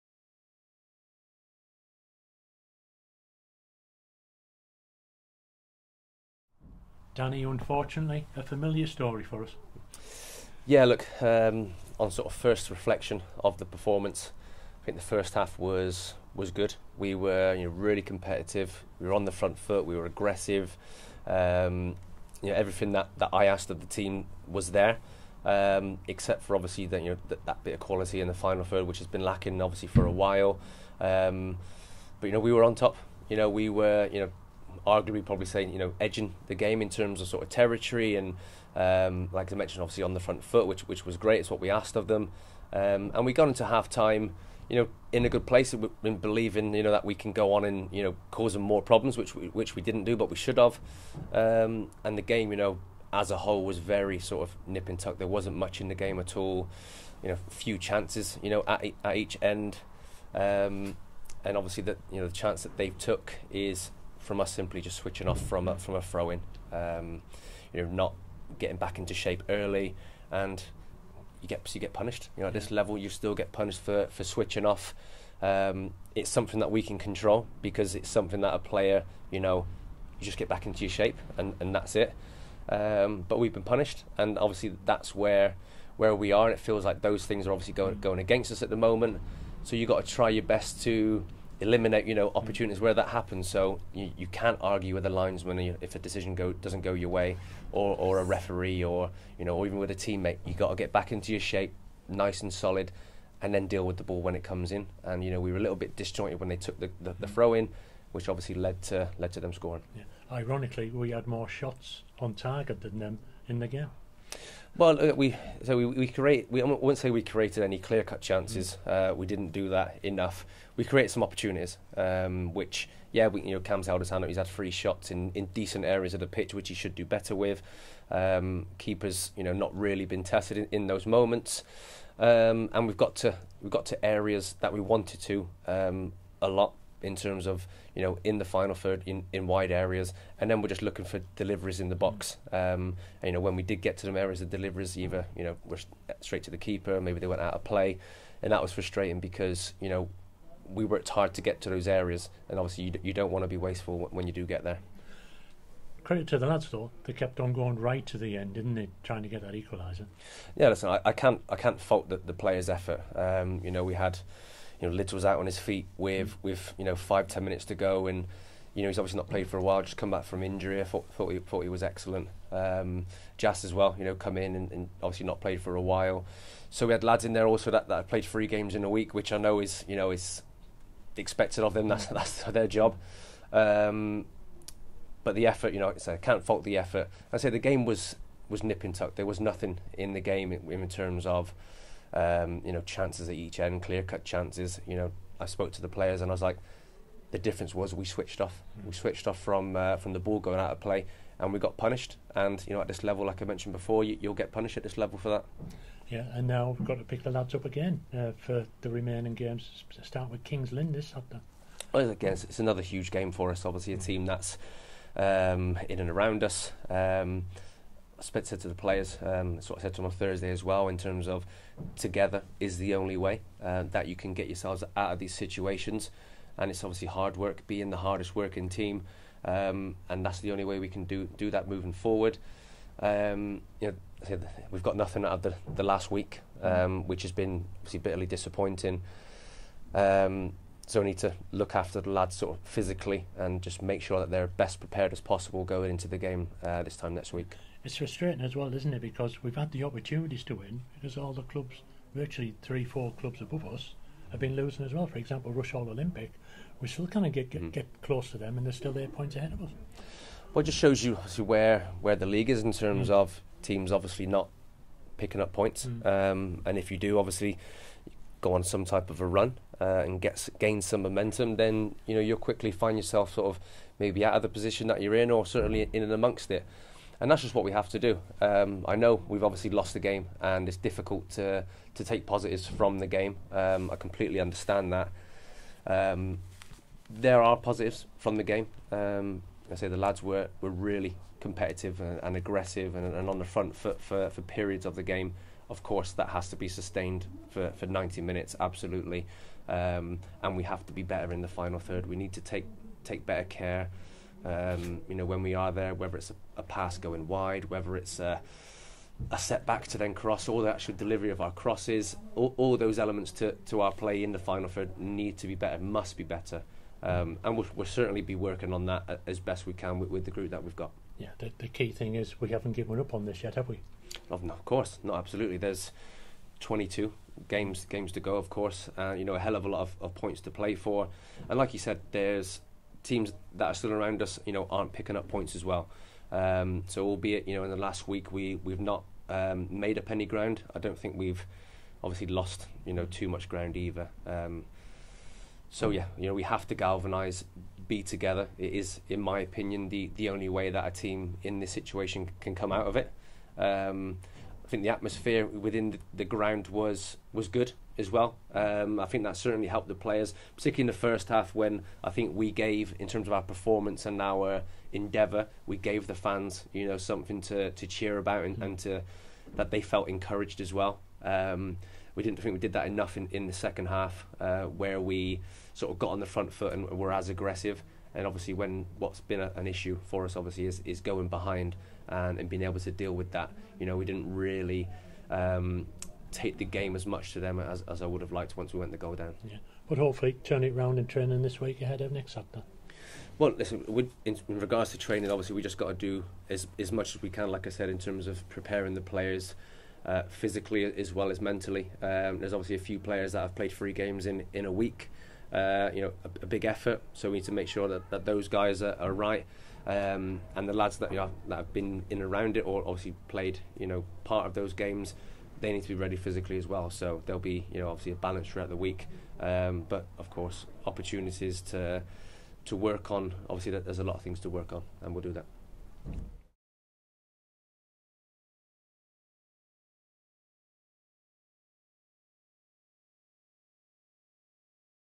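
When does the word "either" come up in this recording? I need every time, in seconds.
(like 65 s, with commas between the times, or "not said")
144 s, 343 s.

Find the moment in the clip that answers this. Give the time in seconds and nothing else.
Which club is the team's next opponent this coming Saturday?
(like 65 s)
210 s.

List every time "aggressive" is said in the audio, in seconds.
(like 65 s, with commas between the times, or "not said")
20 s, 292 s, 377 s.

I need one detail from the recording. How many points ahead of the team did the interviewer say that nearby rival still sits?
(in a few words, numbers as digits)
8.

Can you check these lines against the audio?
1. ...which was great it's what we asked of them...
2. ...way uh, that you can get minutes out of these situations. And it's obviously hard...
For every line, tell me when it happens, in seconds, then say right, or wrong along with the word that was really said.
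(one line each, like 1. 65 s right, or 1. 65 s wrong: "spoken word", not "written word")
1. 40 s right
2. 223 s wrong: "yourselves", not "minutes".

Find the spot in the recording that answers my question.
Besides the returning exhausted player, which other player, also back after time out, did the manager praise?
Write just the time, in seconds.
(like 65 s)
173 s.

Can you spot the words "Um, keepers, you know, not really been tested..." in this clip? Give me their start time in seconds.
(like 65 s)
128 s.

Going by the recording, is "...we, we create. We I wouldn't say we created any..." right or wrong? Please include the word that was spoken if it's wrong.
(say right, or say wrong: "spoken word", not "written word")
right.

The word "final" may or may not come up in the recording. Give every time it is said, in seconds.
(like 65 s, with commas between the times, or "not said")
28 s, 138 s, 301 s, 314 s.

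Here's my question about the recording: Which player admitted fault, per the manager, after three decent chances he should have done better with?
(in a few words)
Cam.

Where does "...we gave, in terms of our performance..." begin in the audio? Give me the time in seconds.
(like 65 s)
362 s.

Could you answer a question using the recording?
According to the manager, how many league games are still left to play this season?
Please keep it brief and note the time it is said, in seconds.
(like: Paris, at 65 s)
22, at 326 s.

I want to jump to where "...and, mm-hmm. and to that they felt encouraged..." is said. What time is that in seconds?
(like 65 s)
368 s.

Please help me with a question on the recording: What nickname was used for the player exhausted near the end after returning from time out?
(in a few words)
Lids.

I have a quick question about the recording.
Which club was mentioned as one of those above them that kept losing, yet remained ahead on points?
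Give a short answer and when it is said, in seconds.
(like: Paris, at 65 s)
Rushall Olympic, at 255 s.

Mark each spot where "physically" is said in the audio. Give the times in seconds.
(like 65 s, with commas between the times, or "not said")
242 s, 400 s, 416 s.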